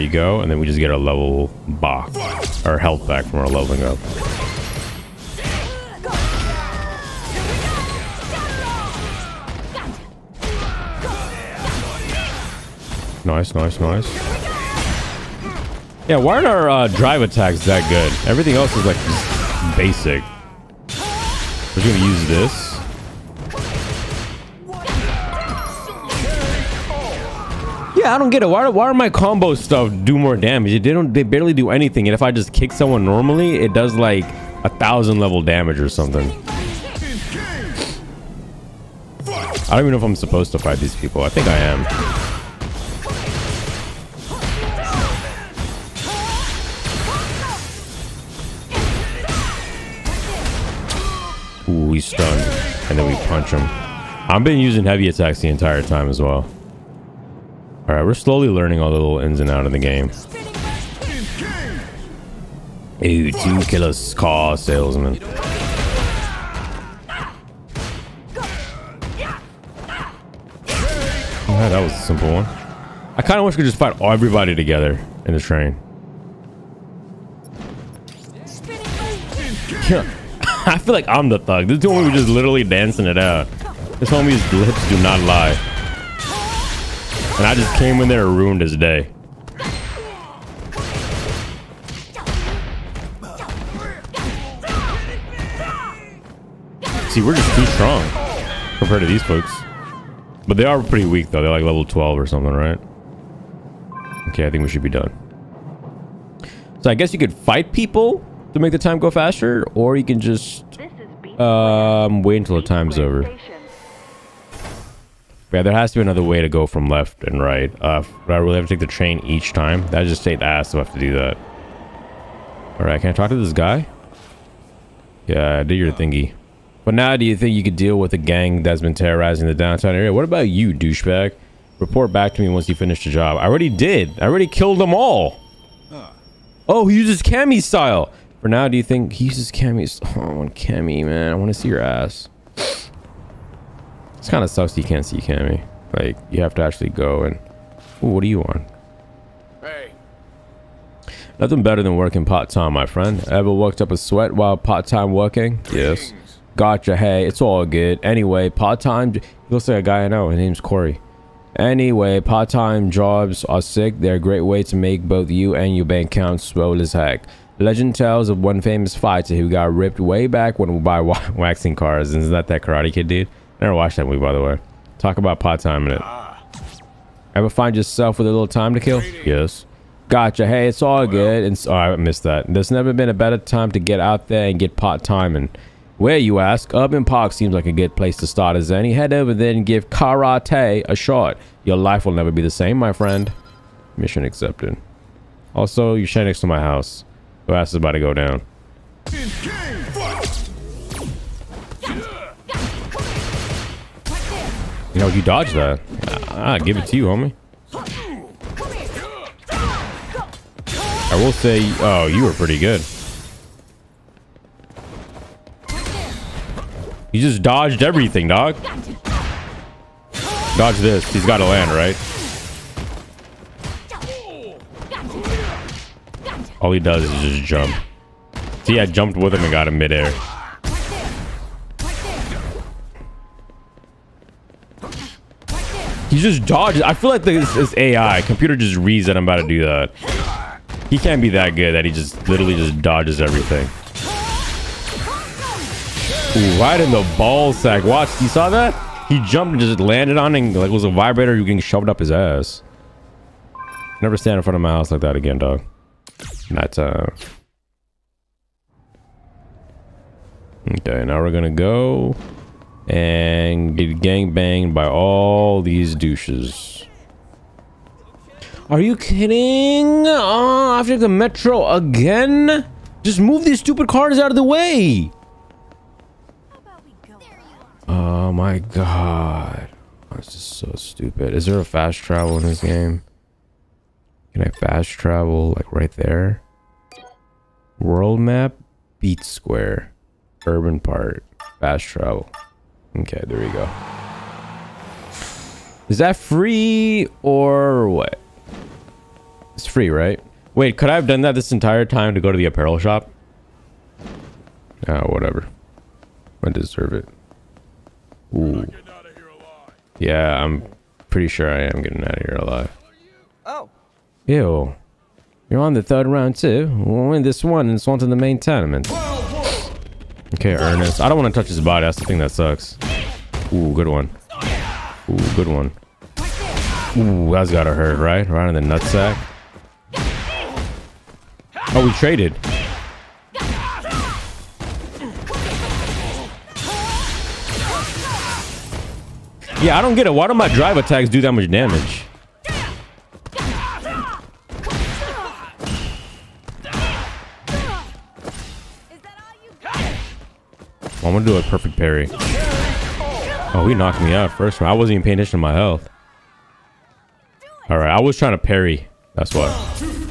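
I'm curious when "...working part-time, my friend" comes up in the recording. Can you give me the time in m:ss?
2:31.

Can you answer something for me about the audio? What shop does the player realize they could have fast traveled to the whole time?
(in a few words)
Apparel shop.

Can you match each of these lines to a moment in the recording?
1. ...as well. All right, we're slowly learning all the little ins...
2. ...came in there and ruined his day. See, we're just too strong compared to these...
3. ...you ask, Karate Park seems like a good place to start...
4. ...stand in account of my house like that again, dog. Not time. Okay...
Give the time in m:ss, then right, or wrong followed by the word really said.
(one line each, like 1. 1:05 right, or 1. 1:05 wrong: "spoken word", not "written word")
1. 0:56 right
2. 1:27 right
3. 3:06 wrong: "Urban", not "Karate"
4. 4:14 wrong: "front", not "account".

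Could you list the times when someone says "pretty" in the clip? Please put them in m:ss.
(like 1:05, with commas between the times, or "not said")
1:40, 3:32, 5:11.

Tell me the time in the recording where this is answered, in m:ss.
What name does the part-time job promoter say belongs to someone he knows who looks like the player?
2:40.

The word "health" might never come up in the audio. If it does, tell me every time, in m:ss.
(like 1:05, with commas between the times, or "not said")
0:02, 5:55.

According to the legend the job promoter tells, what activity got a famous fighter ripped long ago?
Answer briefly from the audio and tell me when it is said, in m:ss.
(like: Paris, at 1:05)
Waxing cars, at 2:51.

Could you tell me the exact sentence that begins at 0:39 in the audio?
I don't even know if I'm supposed to fight these people.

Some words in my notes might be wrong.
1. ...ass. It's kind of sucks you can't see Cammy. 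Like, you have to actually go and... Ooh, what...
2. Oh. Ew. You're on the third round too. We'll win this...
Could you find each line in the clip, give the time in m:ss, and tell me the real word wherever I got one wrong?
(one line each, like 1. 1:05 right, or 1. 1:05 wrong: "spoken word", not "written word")
1. 2:21 right
2. 5:13 right.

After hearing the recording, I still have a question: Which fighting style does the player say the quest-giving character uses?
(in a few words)
Cammy style.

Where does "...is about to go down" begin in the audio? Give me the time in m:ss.
3:17.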